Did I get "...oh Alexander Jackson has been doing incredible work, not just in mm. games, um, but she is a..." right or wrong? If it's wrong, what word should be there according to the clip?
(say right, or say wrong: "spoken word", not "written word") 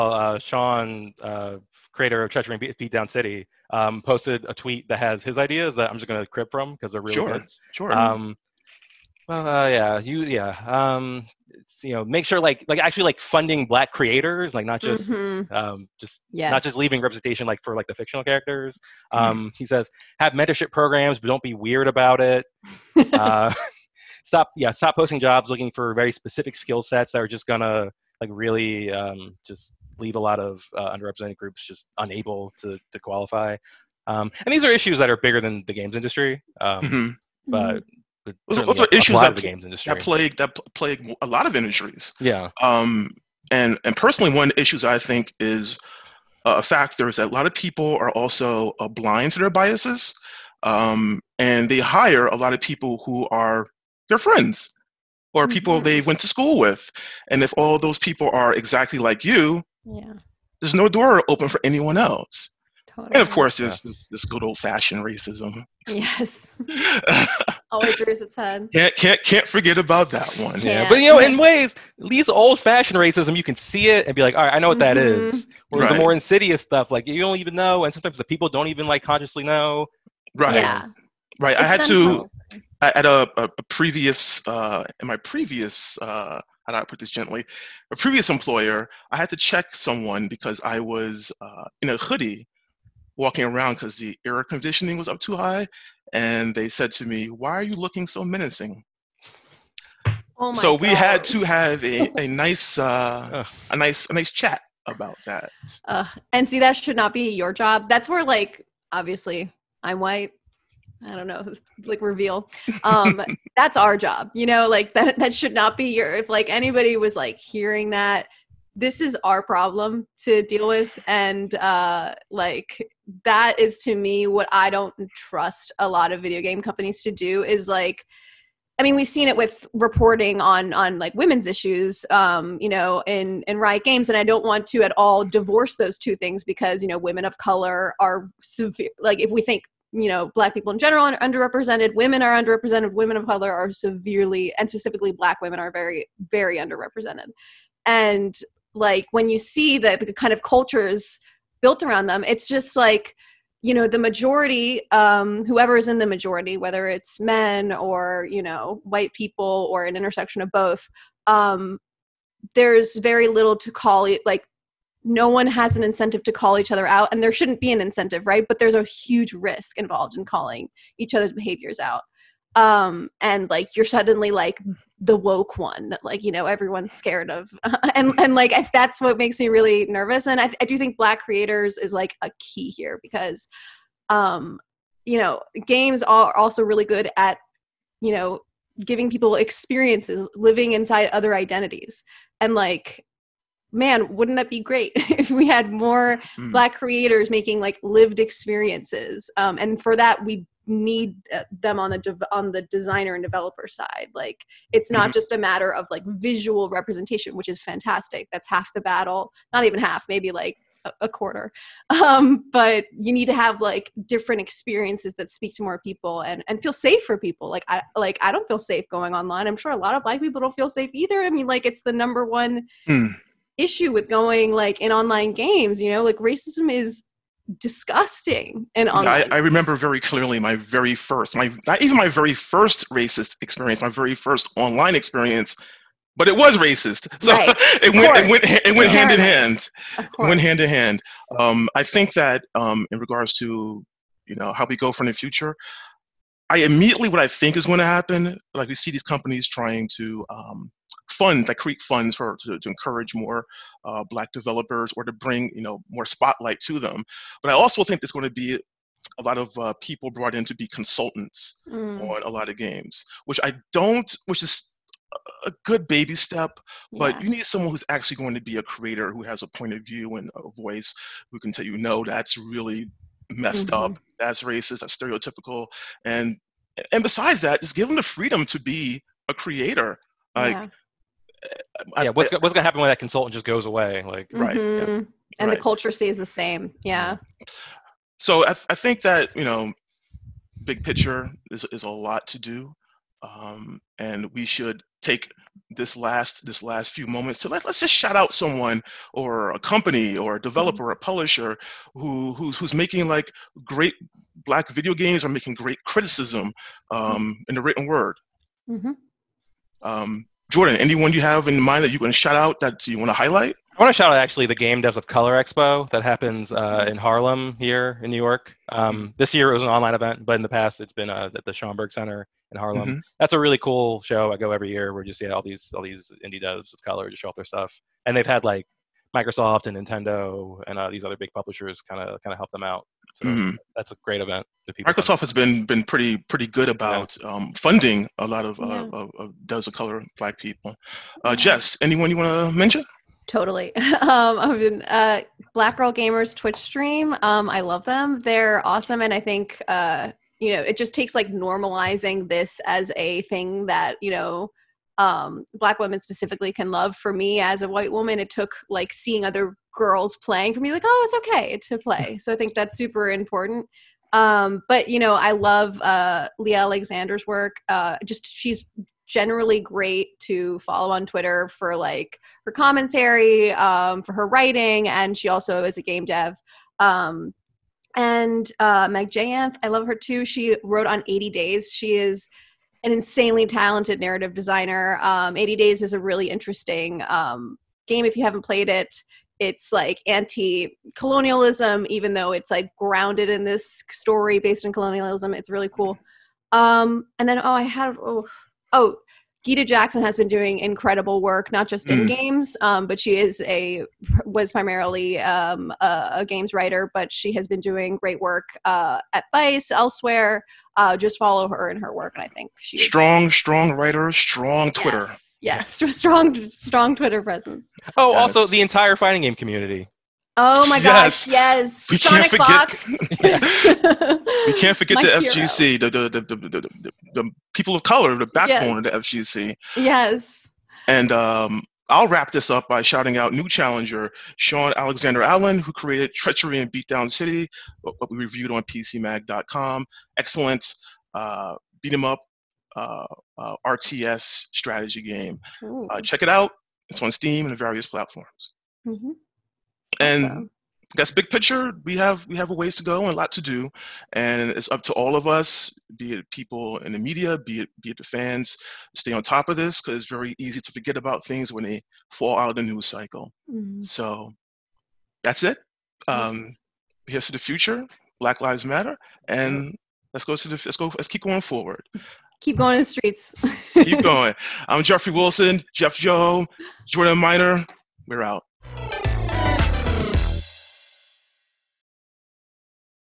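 wrong: "Gita", not "Alexander".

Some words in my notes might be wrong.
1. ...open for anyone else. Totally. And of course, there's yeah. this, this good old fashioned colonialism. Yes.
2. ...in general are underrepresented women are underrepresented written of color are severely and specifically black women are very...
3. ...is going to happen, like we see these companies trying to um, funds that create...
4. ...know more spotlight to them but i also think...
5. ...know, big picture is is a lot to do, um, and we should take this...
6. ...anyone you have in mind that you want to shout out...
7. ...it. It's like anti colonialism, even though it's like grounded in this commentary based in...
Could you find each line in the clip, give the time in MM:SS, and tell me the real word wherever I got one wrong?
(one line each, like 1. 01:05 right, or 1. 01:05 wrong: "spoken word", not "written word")
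1. 01:01 wrong: "racism", not "colonialism"
2. 02:20 wrong: "women", not "written"
3. 04:07 right
4. 04:15 right
5. 04:49 right
6. 05:10 right
7. 06:28 wrong: "story", not "commentary".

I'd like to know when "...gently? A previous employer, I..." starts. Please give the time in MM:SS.
01:27.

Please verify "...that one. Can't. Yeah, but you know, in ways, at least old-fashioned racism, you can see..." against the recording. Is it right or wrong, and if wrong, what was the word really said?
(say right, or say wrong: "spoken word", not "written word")
right.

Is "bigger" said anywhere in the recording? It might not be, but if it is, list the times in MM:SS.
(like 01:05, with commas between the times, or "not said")
00:35.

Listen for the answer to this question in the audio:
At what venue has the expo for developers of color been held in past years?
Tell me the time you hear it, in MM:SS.
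05:21.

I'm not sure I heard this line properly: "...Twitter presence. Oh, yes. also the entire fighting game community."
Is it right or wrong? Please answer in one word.
right.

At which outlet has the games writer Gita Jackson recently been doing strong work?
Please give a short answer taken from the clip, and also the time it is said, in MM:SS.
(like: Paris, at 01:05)
Vice, at 06:49.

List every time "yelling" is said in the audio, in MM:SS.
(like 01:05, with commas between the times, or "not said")
not said.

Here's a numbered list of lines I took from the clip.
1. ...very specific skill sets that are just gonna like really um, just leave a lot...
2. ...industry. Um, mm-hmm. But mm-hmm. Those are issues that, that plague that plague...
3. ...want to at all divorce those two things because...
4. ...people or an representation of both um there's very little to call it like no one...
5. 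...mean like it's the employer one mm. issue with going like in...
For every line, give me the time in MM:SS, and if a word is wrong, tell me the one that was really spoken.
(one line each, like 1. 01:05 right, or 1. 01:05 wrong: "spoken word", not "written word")
1. 00:25 right
2. 00:35 right
3. 02:14 right
4. 02:39 wrong: "intersection", not "representation"
5. 03:41 wrong: "number", not "employer".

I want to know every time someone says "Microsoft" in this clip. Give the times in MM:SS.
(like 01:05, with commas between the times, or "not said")
05:29, 05:34.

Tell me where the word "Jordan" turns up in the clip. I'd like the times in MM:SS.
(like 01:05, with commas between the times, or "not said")
05:10, 07:56.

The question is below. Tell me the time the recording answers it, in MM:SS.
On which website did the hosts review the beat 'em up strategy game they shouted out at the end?
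07:18.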